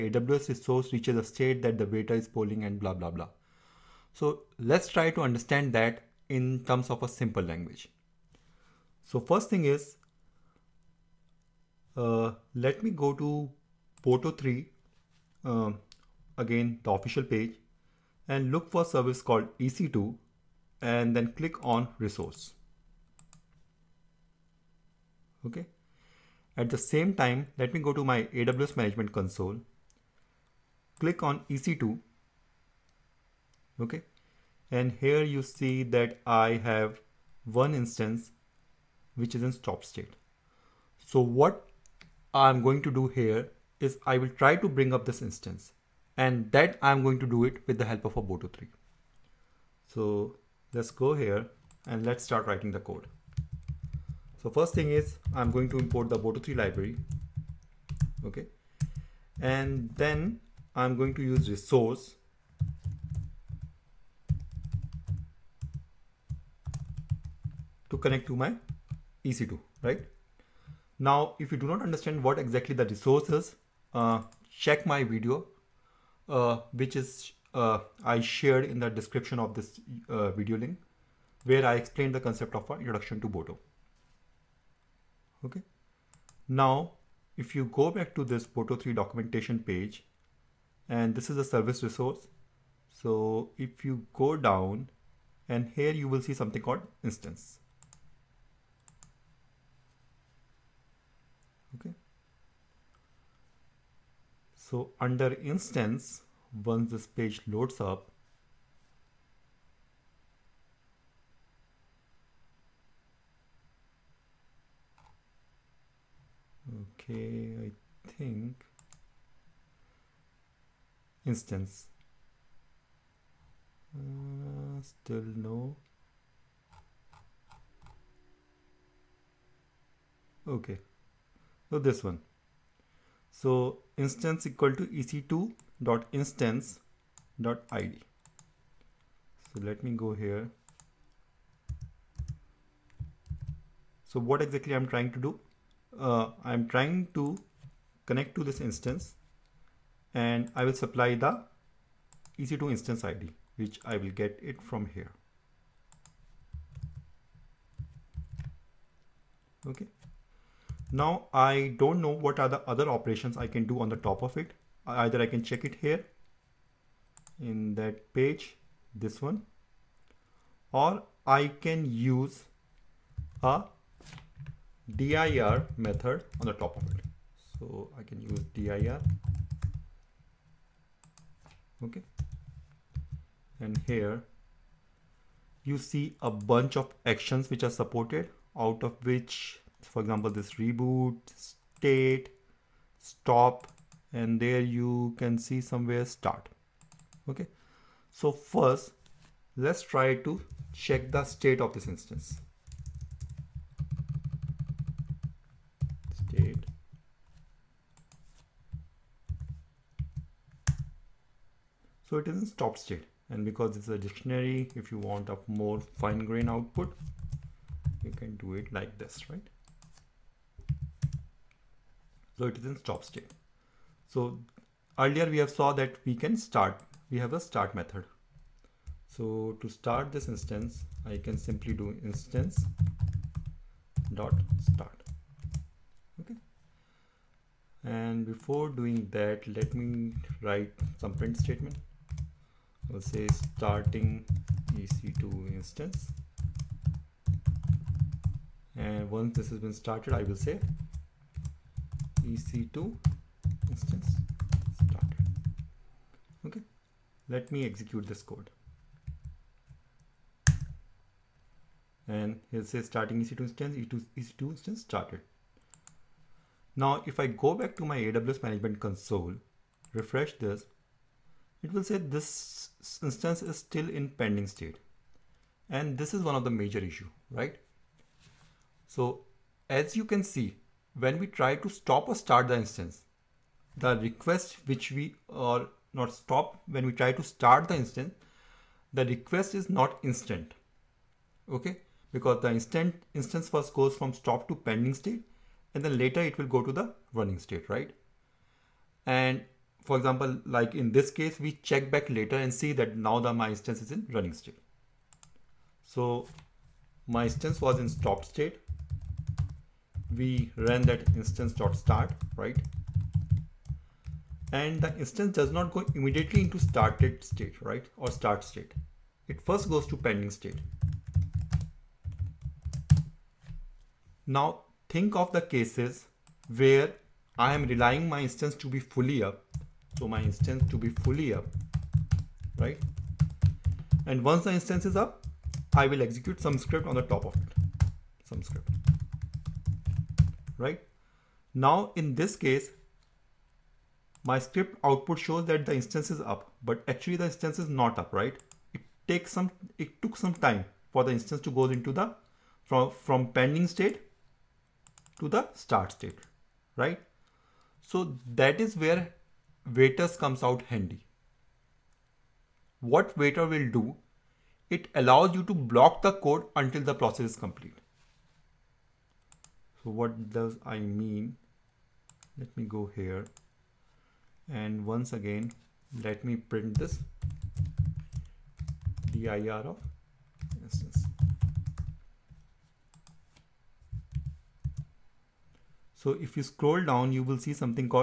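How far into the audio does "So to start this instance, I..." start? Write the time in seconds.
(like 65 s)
229 s.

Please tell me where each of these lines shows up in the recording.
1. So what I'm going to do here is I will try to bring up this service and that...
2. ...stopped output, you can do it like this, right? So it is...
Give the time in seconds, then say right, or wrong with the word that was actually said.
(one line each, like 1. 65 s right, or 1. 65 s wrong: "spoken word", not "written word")
1. 41 s wrong: "instance", not "service"
2. 216 s wrong: "grained", not "stopped".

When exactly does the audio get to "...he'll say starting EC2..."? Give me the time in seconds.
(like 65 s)
262 s.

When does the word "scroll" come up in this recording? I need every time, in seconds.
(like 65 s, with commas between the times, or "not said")
386 s.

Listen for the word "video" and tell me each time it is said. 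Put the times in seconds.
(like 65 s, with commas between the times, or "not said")
75 s, 80 s.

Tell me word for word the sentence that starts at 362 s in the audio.
What waiter will do, it allows you to block the code until the process is complete.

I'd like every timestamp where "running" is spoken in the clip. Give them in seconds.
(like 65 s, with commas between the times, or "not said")
297 s, 304 s.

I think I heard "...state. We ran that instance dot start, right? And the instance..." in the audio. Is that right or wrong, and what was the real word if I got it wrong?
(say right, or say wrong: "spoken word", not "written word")
right.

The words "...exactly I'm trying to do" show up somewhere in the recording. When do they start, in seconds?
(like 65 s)
144 s.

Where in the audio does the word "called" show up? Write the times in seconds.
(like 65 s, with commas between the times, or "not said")
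19 s, 96 s.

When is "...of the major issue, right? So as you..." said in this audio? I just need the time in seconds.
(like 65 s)
276 s.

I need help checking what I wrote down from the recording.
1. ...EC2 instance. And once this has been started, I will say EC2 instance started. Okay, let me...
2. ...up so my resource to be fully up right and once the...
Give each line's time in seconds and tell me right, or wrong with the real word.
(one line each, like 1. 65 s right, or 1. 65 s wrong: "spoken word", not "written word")
1. 244 s right
2. 329 s wrong: "instance", not "resource".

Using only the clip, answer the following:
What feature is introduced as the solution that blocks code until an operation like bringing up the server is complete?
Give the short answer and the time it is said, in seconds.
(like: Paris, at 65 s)
waiters, at 359 s.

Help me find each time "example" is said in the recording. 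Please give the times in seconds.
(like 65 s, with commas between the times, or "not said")
190 s, 299 s.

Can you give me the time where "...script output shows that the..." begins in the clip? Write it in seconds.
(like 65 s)
344 s.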